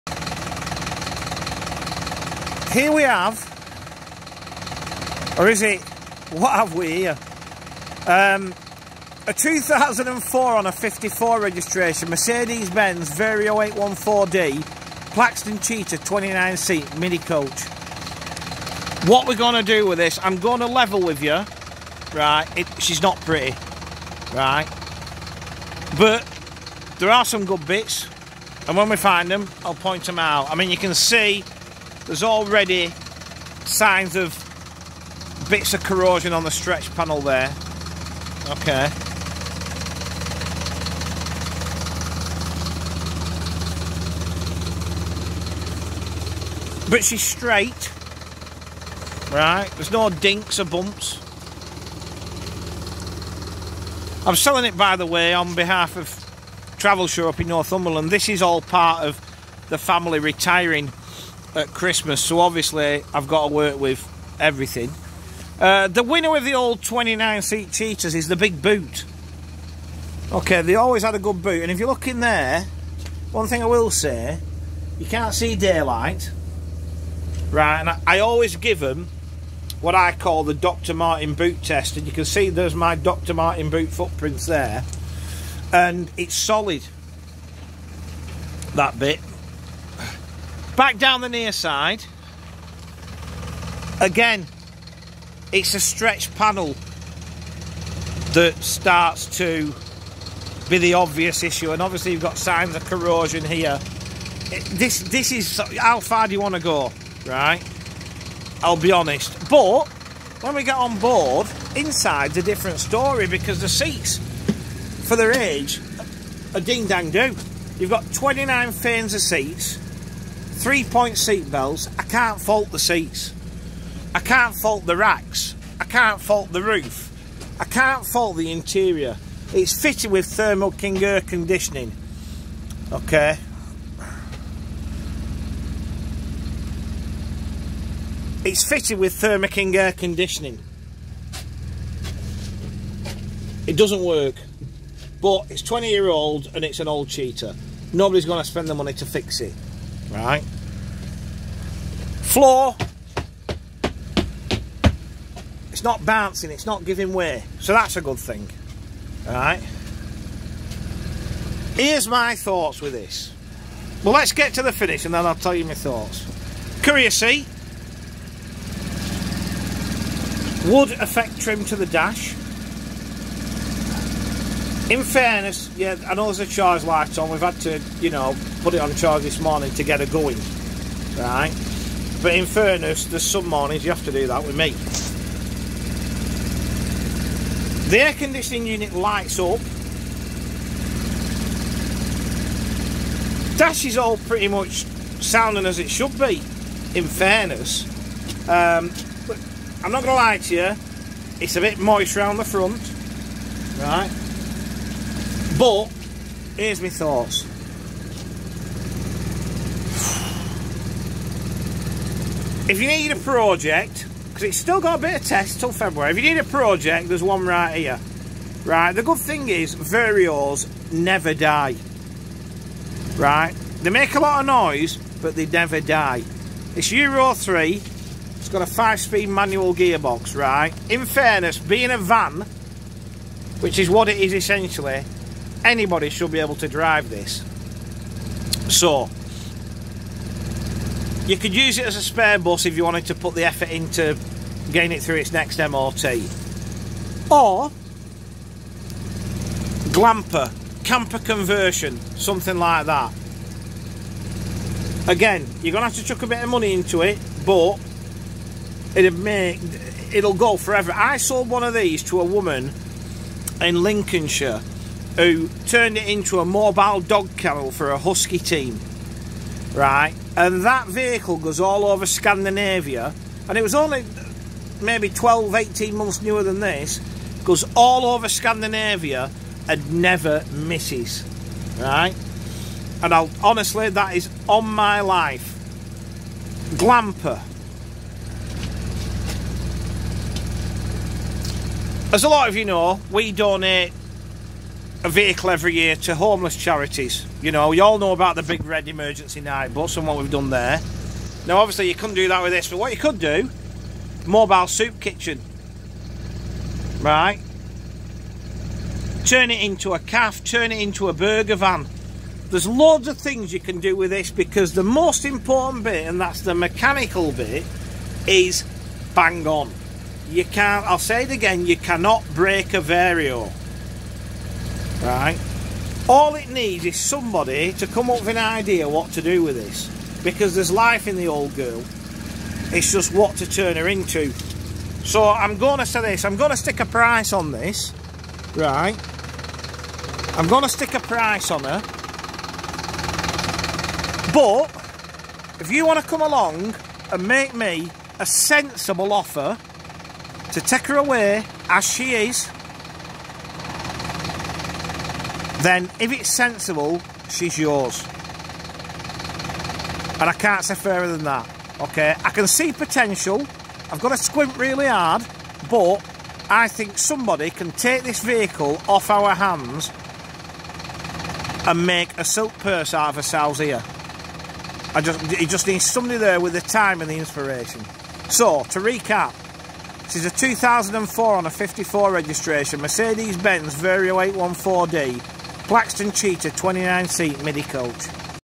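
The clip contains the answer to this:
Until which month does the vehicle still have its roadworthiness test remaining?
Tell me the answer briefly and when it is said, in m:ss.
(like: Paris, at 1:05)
February, at 3:35.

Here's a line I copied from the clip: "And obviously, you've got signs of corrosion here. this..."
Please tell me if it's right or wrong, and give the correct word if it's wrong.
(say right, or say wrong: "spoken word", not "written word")
right.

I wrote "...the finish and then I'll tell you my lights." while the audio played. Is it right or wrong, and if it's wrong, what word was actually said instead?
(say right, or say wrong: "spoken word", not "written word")
wrong: "thoughts", not "lights".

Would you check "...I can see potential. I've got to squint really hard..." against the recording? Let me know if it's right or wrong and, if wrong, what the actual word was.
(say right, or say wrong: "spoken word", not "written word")
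right.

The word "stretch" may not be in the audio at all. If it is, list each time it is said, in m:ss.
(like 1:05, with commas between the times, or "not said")
0:36, 1:35.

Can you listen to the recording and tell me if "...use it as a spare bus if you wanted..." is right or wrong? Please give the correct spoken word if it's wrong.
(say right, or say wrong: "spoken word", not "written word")
right.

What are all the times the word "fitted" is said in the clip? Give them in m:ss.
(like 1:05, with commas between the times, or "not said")
2:09, 2:18.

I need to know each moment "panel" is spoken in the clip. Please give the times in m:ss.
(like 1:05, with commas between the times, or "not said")
0:36, 1:36.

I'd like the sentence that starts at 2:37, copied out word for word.
So that's a good thing, right?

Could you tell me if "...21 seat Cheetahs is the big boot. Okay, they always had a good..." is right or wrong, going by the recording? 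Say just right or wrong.
wrong.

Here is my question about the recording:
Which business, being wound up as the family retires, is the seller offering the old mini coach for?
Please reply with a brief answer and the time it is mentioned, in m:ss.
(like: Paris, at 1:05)
Travel Show, at 0:56.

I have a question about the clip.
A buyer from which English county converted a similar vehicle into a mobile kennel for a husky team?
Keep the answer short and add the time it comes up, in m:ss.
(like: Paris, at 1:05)
Lincolnshire, at 4:23.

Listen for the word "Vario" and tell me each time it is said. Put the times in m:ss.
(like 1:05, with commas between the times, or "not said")
0:13, 3:39, 5:22, 6:23.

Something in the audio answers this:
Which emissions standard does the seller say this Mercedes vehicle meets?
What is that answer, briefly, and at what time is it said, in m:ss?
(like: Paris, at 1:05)
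Euro 3, at 3:46.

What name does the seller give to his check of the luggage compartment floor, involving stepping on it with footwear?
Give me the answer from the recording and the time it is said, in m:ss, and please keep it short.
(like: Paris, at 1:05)
Dr. Martin boot test, at 1:20.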